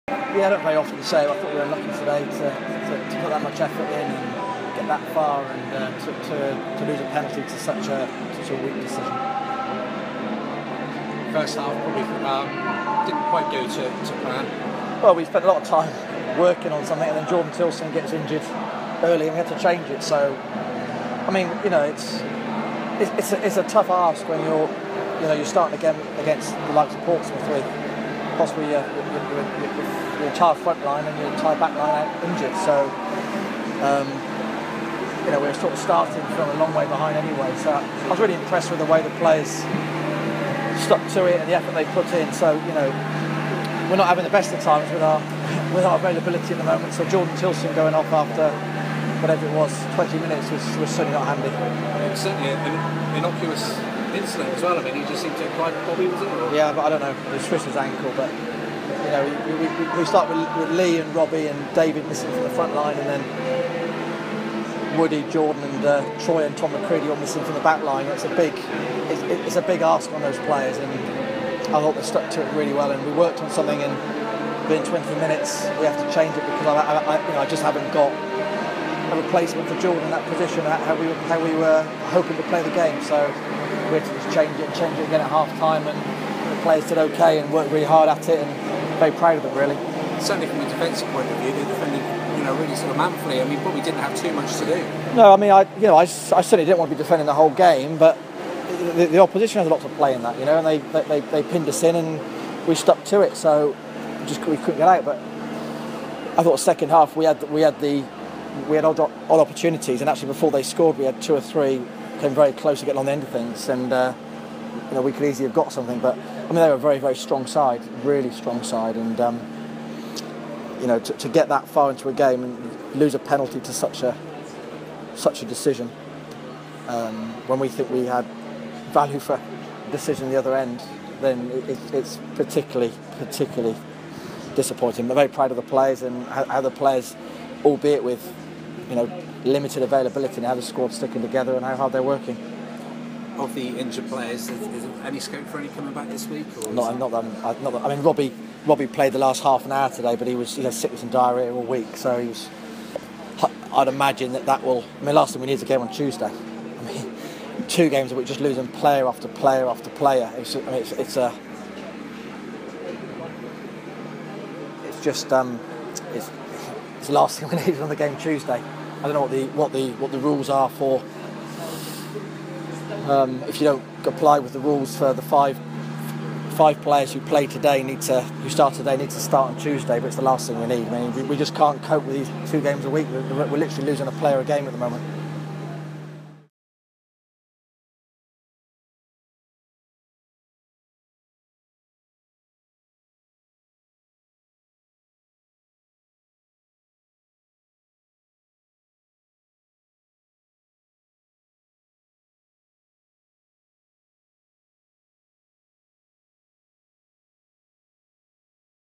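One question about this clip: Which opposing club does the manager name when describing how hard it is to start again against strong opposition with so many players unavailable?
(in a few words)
Portsmouth.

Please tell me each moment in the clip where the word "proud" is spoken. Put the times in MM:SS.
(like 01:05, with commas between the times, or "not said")
01:29, 02:15.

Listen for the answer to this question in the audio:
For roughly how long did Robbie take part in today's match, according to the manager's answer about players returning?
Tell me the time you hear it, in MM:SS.
02:29.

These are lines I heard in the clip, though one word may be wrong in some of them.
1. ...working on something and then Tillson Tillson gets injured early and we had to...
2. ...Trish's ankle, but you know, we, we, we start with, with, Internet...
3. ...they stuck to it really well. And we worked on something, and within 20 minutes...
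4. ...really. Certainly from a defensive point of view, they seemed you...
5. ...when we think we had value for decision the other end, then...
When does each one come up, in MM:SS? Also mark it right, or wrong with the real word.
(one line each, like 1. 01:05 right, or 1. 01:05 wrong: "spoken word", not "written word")
1. 00:16 wrong: "Jordan", not "Tillson"
2. 00:57 wrong: "Lee", not "Internet"
3. 01:11 right
4. 01:29 wrong: "defended", not "seemed"
5. 02:07 right.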